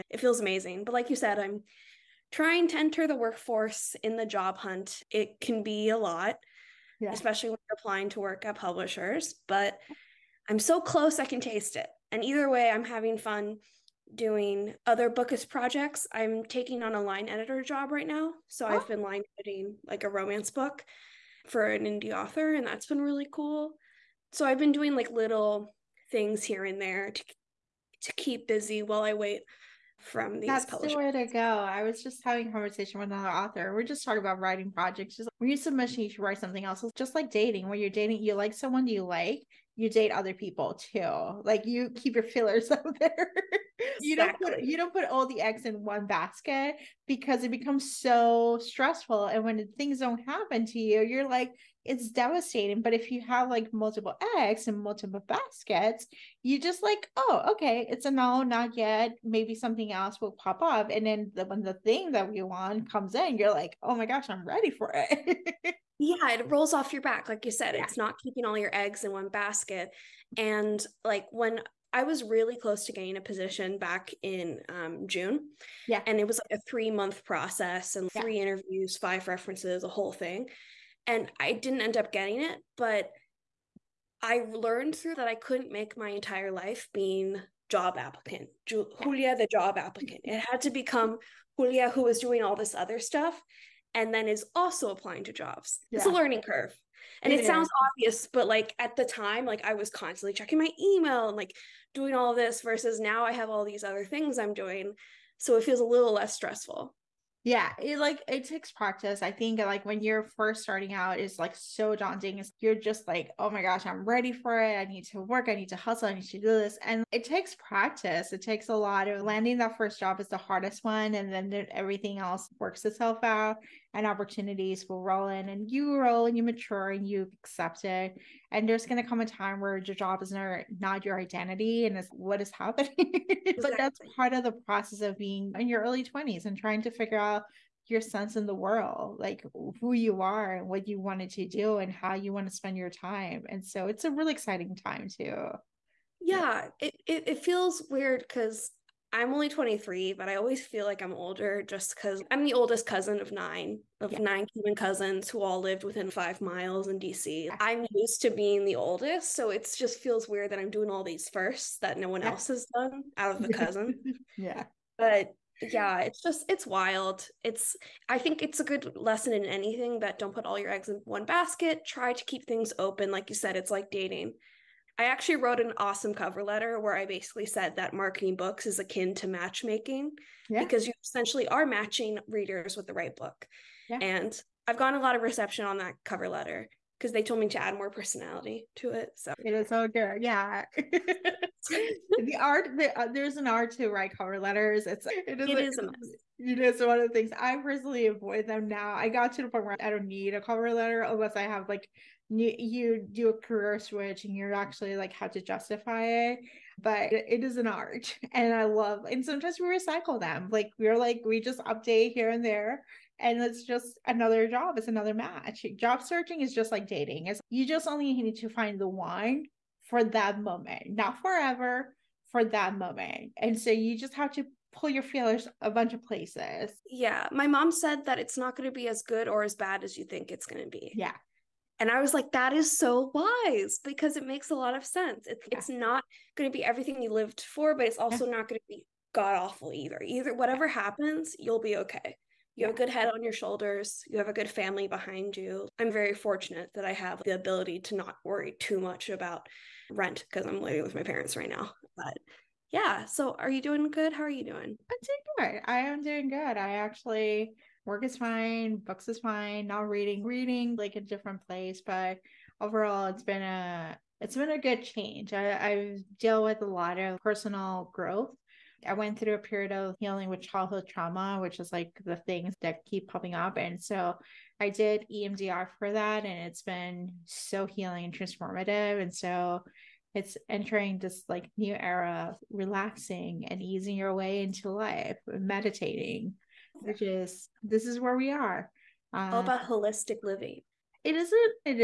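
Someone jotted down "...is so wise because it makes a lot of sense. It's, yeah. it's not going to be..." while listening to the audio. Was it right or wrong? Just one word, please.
right.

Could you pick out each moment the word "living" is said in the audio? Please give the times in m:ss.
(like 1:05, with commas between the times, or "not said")
4:10, 4:50.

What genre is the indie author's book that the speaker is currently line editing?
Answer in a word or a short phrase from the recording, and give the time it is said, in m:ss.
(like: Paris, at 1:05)
Romance, at 0:20.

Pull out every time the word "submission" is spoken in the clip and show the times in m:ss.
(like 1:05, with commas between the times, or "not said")
0:35.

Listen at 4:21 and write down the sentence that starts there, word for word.
But overall, it's been a it's been a good change.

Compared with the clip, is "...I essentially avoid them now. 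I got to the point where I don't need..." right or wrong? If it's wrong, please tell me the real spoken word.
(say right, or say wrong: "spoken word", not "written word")
wrong: "personally", not "essentially".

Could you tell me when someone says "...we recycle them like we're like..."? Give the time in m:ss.
3:29.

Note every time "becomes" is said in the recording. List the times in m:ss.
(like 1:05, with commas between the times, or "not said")
0:47, 1:30.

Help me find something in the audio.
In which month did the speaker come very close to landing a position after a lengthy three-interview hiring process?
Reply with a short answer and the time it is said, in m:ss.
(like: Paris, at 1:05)
June, at 1:15.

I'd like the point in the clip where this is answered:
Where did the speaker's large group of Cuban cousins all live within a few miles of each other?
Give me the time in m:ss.
2:36.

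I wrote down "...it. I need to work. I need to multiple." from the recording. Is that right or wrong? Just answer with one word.
wrong.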